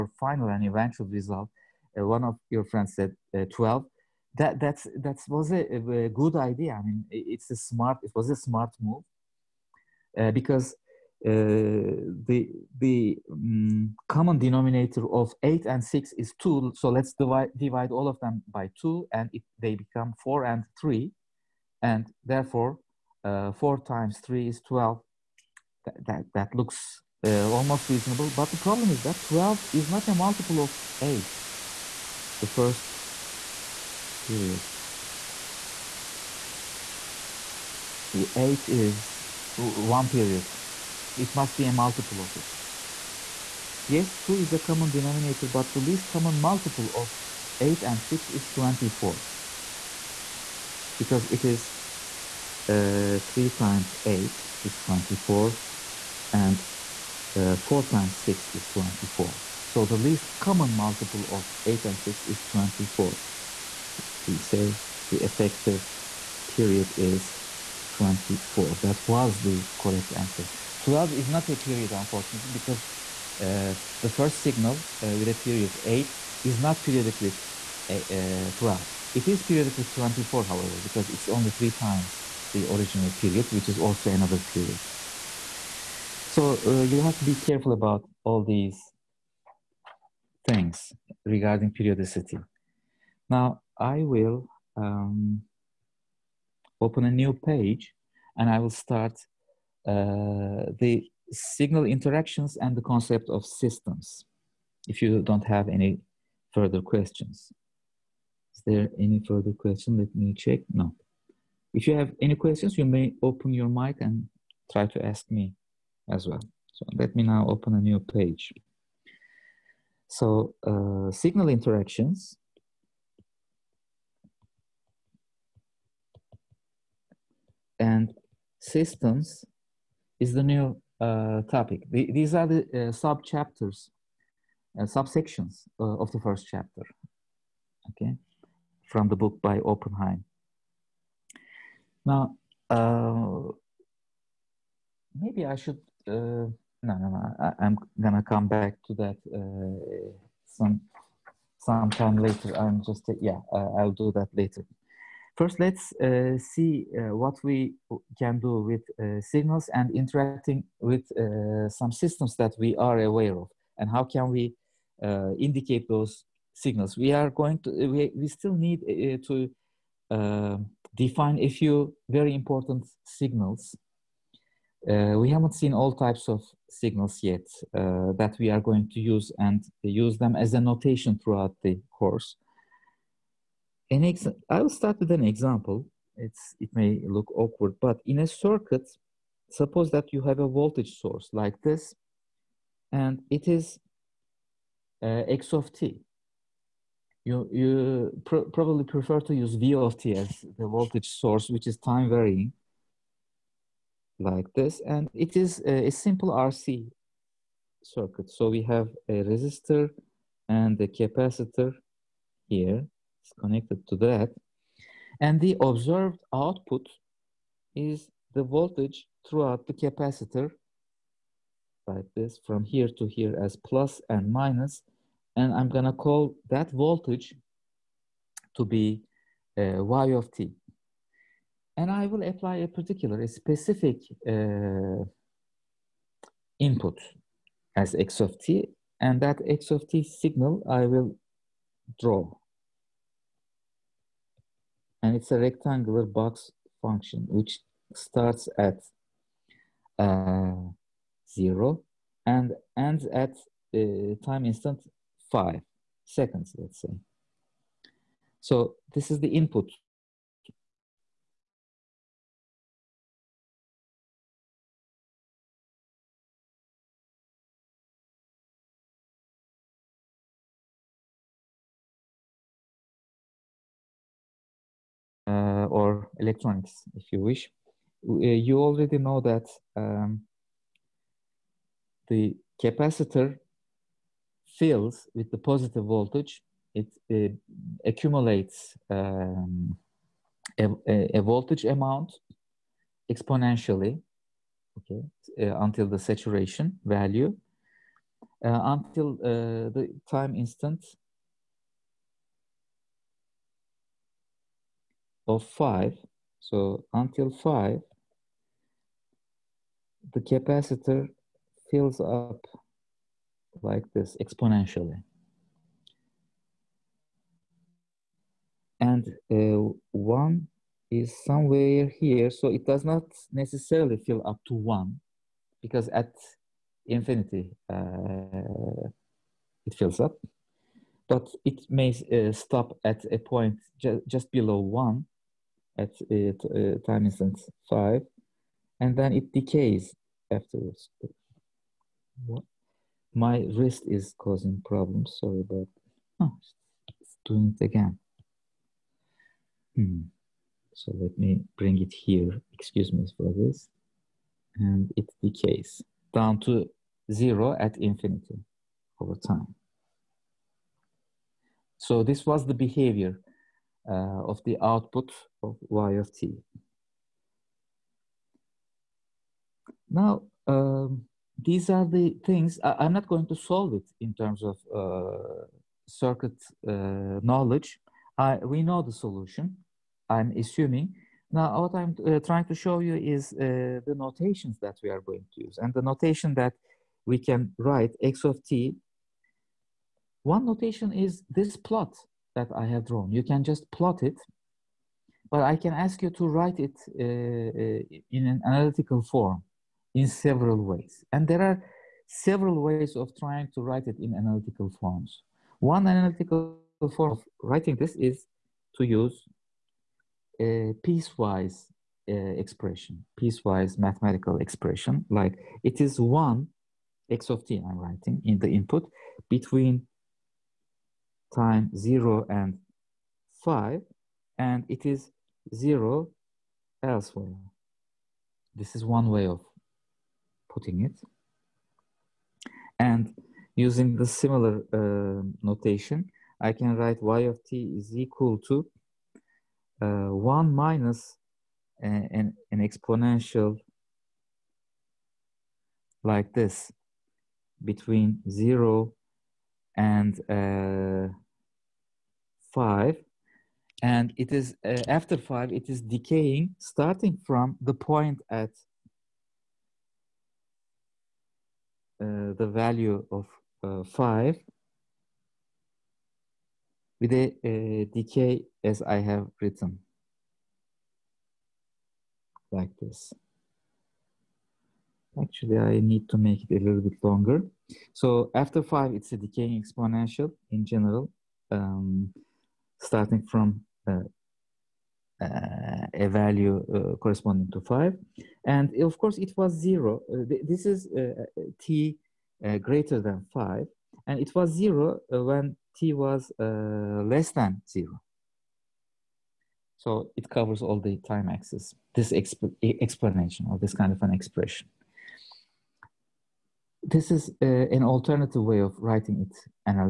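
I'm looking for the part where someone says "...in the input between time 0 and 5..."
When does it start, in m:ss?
6:58.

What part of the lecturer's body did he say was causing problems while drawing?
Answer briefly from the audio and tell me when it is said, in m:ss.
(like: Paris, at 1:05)
wrist, at 5:43.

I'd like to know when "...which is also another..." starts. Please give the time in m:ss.
1:23.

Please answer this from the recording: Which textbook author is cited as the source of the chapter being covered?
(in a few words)
Oppenheim.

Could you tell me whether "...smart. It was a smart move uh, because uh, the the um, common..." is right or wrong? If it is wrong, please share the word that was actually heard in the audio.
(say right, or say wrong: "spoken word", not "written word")
right.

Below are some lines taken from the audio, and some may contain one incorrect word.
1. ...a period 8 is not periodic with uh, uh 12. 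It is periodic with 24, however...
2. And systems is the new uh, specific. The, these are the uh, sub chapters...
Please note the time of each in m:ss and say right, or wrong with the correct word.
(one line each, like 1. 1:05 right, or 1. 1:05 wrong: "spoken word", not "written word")
1. 1:15 right
2. 2:07 wrong: "topic", not "specific".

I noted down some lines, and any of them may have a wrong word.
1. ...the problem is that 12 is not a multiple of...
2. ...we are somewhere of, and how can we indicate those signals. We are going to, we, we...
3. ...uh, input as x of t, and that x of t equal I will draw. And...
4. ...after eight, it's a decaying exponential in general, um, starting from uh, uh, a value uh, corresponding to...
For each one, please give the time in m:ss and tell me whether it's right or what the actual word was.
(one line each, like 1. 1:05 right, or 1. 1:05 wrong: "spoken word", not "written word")
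1. 0:28 right
2. 2:42 wrong: "aware", not "somewhere"
3. 3:54 wrong: "signal", not "equal"
4. 7:58 wrong: "five", not "eight".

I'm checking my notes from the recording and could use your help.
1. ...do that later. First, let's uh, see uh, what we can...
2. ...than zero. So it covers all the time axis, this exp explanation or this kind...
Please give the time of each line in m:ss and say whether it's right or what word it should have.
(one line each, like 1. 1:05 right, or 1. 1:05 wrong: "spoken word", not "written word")
1. 2:33 right
2. 8:17 right.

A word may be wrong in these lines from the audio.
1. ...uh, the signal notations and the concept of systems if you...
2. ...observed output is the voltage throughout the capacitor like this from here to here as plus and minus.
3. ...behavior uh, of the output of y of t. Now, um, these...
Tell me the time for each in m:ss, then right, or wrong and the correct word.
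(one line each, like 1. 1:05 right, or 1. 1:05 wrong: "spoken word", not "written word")
1. 1:39 wrong: "interactions", not "notations"
2. 3:35 right
3. 6:02 right.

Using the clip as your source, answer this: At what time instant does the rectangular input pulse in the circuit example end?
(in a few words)
5 seconds.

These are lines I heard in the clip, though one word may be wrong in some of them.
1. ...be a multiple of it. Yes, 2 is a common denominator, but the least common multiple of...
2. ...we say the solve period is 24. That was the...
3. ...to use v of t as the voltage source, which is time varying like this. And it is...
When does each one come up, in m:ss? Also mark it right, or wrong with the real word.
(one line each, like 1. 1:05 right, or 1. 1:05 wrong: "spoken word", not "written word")
1. 0:41 right
2. 1:04 wrong: "effective", not "solve"
3. 3:19 right.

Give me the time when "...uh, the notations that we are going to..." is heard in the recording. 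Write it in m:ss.
6:23.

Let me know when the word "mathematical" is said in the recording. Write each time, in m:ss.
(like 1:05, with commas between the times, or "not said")
6:53.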